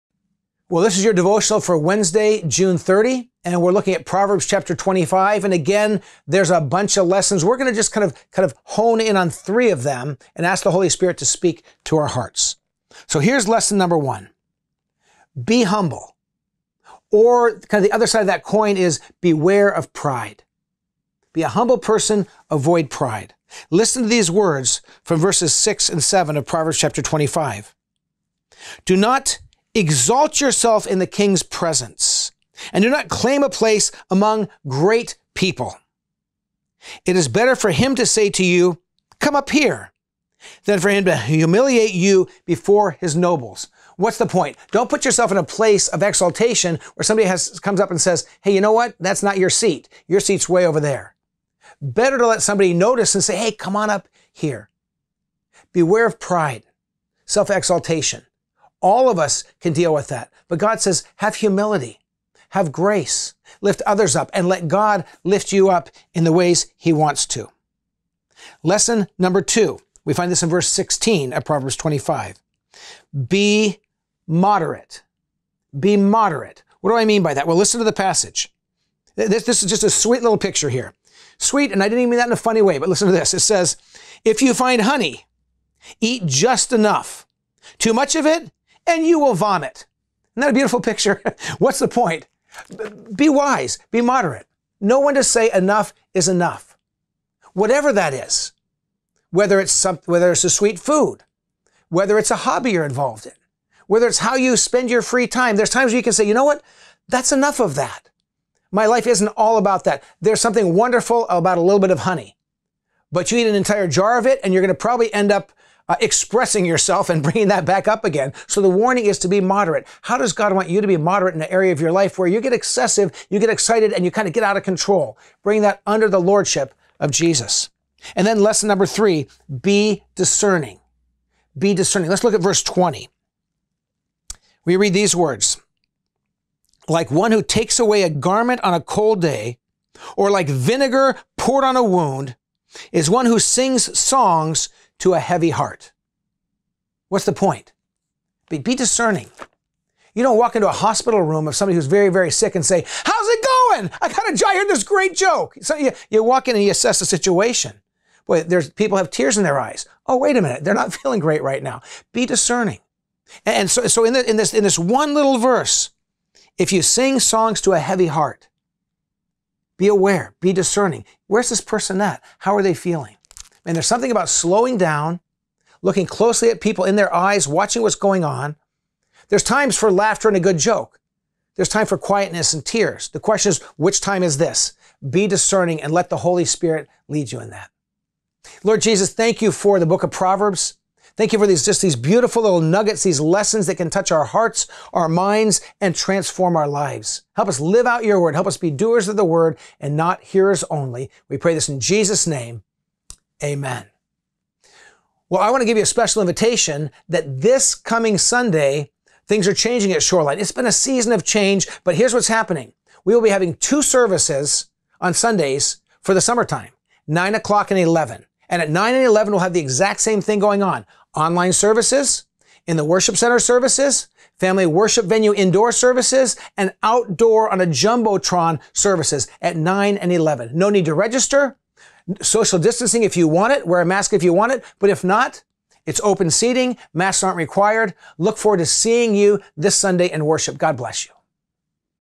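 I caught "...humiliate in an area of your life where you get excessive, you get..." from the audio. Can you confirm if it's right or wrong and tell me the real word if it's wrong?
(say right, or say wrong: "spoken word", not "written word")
wrong: "moderate", not "humiliate".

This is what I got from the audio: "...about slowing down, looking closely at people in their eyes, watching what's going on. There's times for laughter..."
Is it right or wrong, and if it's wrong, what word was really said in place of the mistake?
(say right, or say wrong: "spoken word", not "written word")
right.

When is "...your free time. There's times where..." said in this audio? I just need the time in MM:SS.
01:44.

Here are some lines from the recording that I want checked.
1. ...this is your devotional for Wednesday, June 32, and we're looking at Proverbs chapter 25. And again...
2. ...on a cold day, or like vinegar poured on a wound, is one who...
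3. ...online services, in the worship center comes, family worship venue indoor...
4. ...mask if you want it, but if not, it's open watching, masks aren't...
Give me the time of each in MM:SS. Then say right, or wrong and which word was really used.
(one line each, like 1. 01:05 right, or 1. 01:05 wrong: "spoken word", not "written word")
1. 00:00 wrong: "30", not "32"
2. 02:18 right
3. 03:41 wrong: "services", not "comes"
4. 03:53 wrong: "seating", not "watching".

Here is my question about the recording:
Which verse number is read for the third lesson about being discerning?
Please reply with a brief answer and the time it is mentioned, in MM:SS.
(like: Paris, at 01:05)
Verse 20, at 02:12.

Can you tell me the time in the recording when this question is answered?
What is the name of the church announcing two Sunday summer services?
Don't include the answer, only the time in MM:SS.
03:30.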